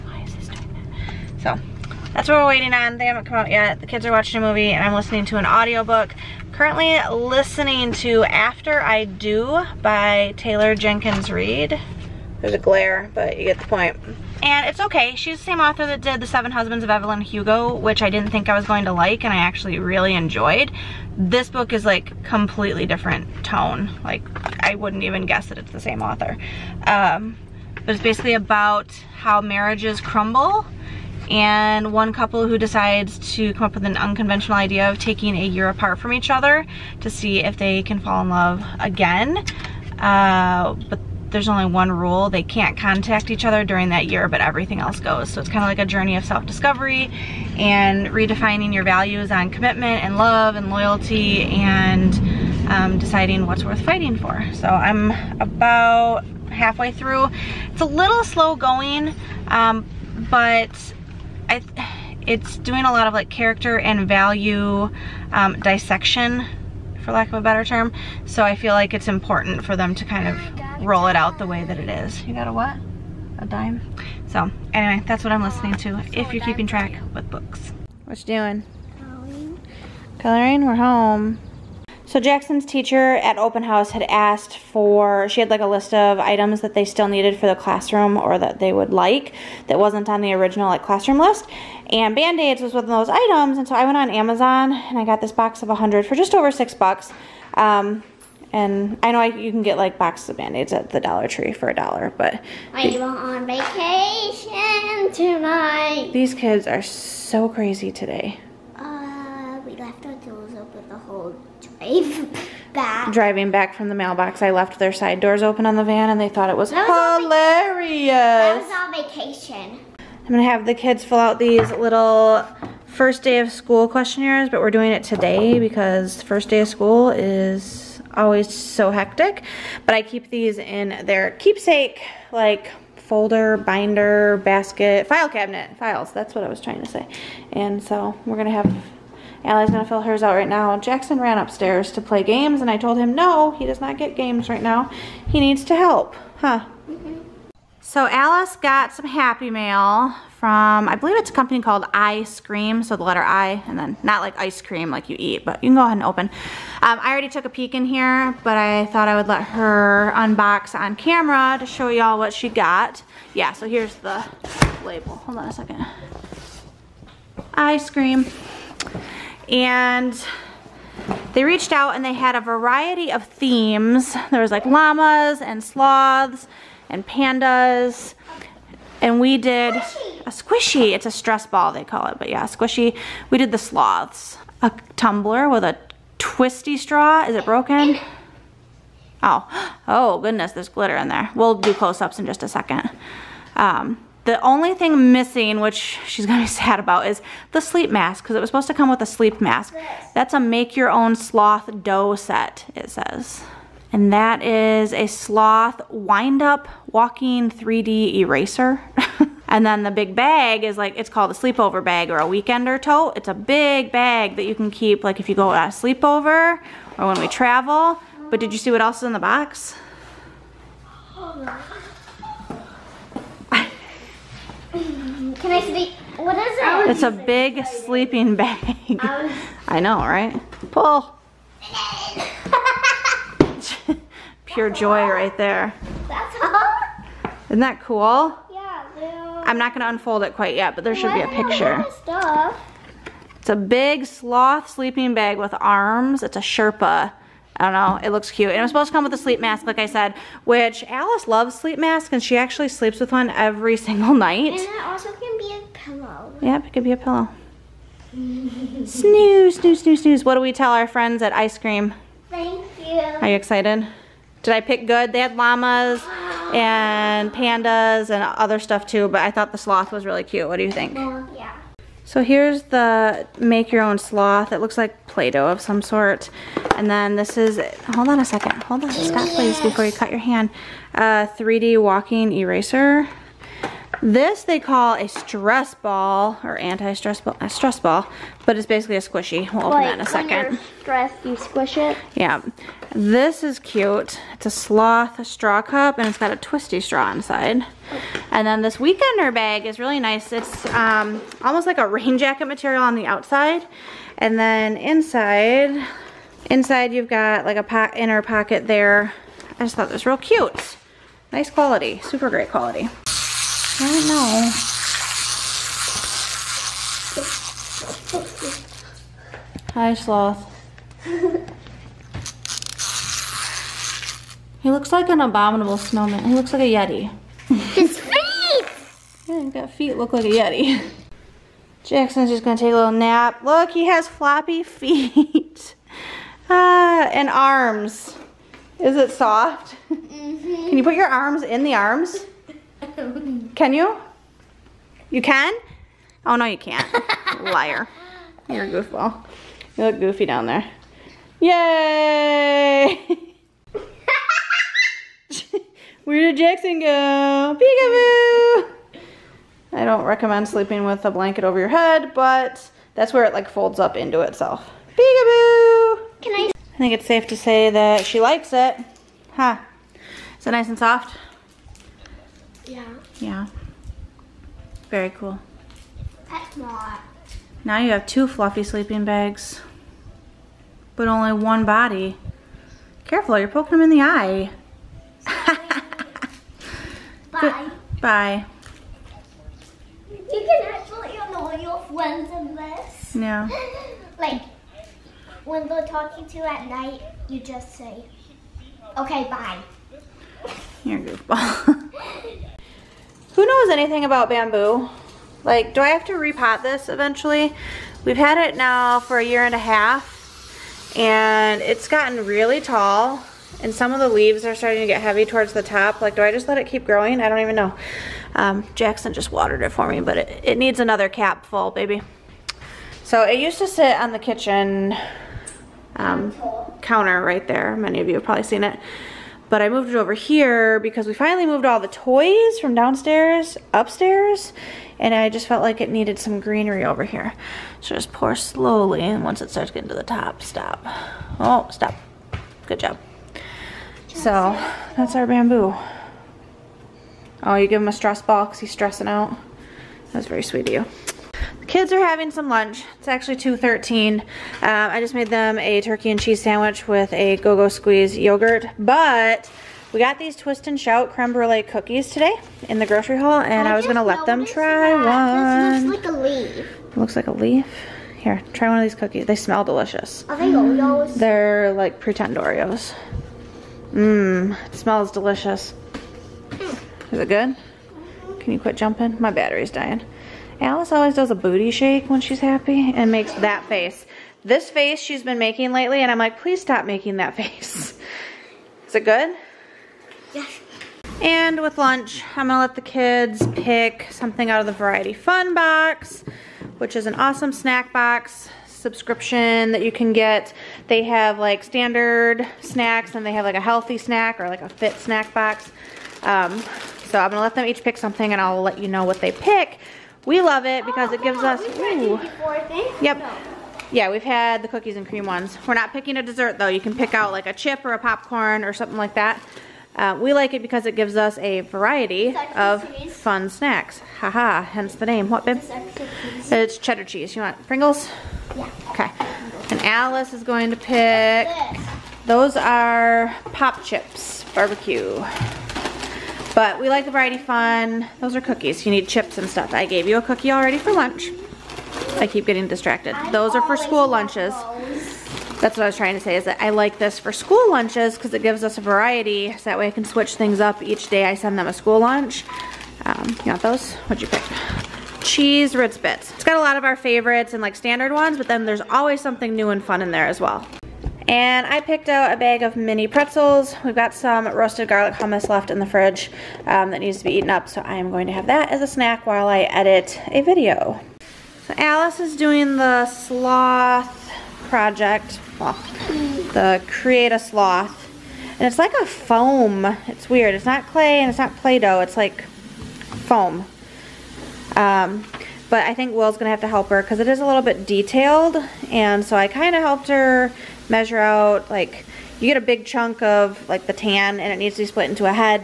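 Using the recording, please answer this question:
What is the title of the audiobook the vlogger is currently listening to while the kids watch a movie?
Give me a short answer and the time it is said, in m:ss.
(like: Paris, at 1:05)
After I Do, at 0:08.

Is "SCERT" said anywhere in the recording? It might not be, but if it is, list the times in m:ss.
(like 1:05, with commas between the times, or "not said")
not said.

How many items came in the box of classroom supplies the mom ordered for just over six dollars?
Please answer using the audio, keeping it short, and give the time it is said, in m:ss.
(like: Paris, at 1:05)
100, at 1:35.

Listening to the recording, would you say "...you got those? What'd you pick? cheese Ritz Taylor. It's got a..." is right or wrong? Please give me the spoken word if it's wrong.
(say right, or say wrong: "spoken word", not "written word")
wrong: "Bits", not "Taylor".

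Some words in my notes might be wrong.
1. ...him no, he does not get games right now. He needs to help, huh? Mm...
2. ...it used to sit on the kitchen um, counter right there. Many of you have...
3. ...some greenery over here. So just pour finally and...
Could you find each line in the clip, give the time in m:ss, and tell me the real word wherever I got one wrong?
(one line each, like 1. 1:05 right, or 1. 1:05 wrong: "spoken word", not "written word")
1. 2:22 right
2. 7:03 right
3. 7:16 wrong: "slowly", not "finally".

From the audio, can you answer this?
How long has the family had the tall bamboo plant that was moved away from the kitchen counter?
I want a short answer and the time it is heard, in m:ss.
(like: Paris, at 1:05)
a year and a half, at 6:49.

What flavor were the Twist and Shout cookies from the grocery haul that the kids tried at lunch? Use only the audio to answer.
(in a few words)
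creme brulee.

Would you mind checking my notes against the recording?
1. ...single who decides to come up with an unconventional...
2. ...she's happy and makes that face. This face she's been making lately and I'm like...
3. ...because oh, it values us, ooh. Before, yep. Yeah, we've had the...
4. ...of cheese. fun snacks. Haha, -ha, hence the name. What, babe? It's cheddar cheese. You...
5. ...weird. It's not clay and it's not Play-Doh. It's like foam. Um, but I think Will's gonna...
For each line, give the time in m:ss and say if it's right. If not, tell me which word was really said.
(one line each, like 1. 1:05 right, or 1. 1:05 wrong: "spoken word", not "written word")
1. 0:32 wrong: "couple", not "single"
2. 8:02 right
3. 8:30 wrong: "gives", not "values"
4. 8:42 right
5. 9:40 right.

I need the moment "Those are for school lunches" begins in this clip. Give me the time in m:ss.
9:03.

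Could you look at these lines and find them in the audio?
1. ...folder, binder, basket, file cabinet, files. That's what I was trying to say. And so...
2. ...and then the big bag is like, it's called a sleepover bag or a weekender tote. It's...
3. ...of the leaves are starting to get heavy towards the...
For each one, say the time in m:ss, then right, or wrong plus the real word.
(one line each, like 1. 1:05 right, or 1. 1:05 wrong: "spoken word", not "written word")
1. 2:12 right
2. 3:29 right
3. 6:53 right.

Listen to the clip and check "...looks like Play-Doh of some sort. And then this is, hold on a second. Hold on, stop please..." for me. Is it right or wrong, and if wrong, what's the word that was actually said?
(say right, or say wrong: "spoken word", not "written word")
right.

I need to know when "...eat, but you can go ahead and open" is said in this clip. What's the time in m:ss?
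2:35.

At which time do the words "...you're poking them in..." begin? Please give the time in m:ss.
6:23.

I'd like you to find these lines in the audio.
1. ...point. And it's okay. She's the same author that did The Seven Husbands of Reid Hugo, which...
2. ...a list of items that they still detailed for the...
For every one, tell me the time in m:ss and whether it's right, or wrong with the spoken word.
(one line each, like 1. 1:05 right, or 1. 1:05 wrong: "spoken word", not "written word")
1. 0:13 wrong: "Evelyn", not "Reid"
2. 1:25 wrong: "needed", not "detailed".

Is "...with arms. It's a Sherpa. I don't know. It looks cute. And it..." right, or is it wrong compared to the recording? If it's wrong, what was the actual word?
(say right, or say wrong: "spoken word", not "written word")
right.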